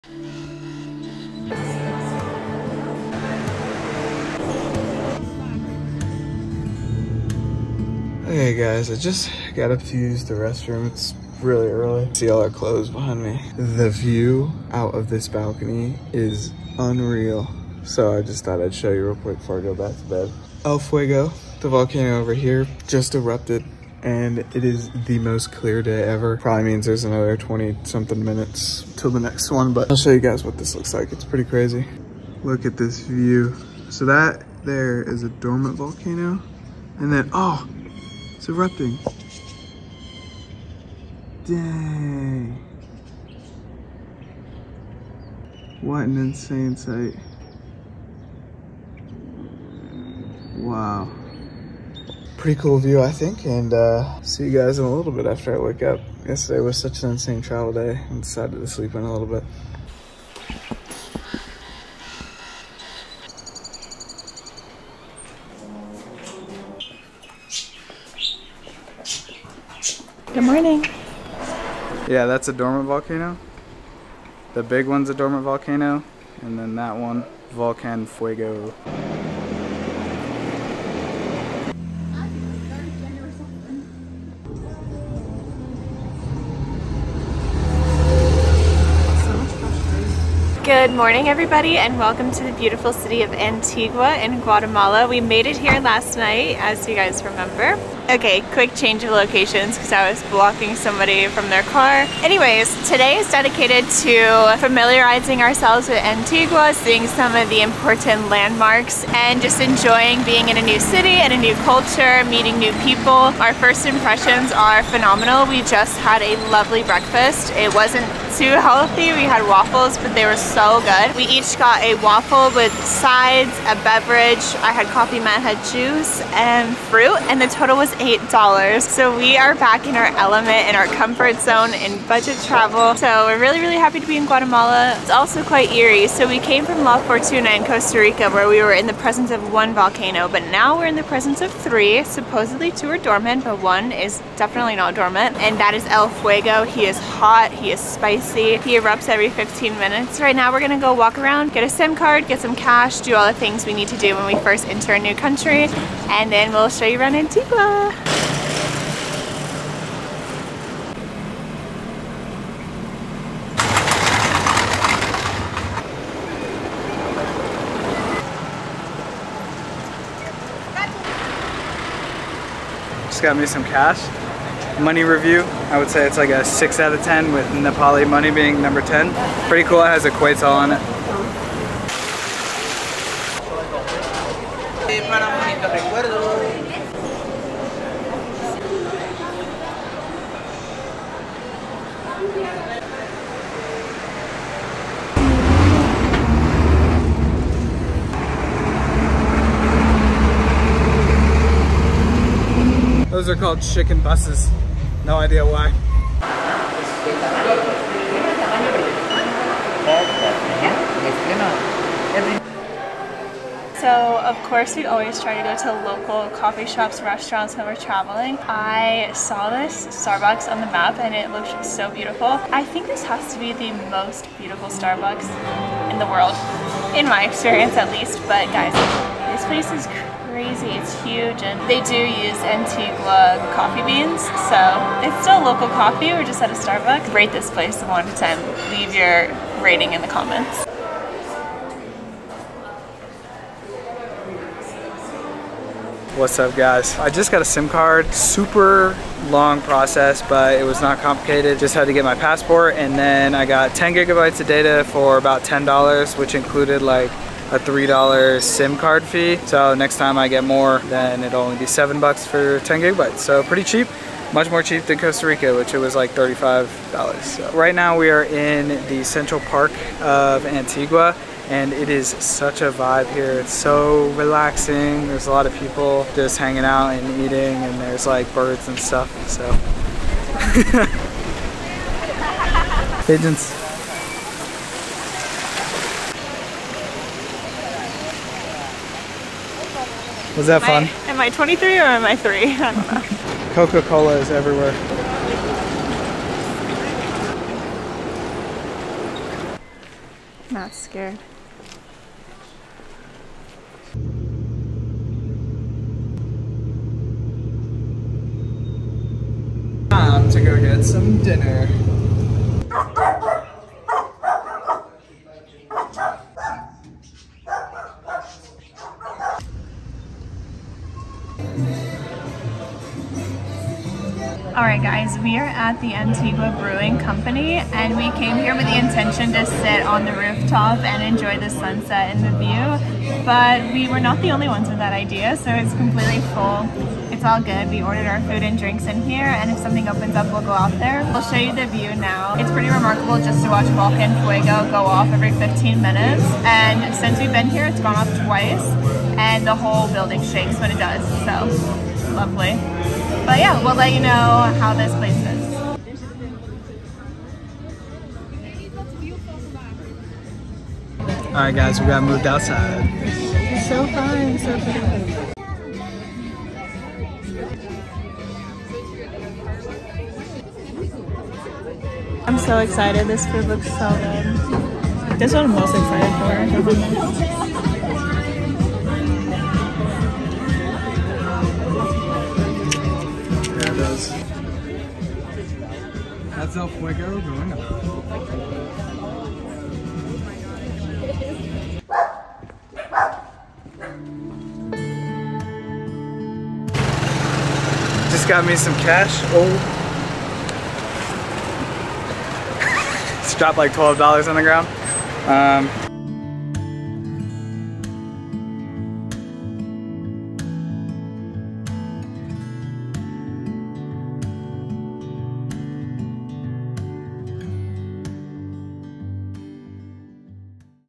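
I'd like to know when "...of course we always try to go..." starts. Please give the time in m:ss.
3:34.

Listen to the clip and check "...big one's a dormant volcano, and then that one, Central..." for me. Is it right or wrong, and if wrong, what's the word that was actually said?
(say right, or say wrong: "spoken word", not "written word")
wrong: "Volcan", not "Central".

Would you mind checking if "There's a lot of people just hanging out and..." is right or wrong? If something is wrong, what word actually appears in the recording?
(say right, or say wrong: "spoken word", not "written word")
right.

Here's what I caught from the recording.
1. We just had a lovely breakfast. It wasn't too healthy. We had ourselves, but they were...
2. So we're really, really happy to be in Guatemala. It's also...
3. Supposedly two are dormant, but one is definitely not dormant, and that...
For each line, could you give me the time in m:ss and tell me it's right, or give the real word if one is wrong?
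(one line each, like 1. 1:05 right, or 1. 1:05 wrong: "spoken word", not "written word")
1. 1:55 wrong: "waffles", not "ourselves"
2. 2:12 right
3. 2:22 right.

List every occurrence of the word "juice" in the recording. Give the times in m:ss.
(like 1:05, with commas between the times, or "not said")
2:05.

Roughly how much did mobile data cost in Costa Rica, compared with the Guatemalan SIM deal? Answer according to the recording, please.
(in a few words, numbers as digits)
$35.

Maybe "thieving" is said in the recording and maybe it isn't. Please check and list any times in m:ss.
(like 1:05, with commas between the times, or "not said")
not said.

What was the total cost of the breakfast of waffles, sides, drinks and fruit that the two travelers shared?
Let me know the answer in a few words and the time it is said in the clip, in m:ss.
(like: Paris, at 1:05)
$8, at 2:07.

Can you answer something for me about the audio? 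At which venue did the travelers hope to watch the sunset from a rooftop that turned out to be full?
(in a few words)
Antigua Brewing Company.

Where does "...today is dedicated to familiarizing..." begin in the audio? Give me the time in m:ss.
1:42.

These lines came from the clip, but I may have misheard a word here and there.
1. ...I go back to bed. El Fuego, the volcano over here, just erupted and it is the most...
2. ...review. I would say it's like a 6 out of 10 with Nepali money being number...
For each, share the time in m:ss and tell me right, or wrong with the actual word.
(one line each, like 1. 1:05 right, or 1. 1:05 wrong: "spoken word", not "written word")
1. 0:19 right
2. 2:55 right.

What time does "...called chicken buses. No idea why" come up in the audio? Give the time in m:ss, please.
3:23.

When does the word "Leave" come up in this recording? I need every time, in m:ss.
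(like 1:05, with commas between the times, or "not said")
3:58.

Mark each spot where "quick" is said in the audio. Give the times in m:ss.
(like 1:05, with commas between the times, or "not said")
0:19, 1:38.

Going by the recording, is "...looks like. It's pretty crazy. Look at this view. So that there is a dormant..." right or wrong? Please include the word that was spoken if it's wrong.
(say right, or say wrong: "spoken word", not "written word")
right.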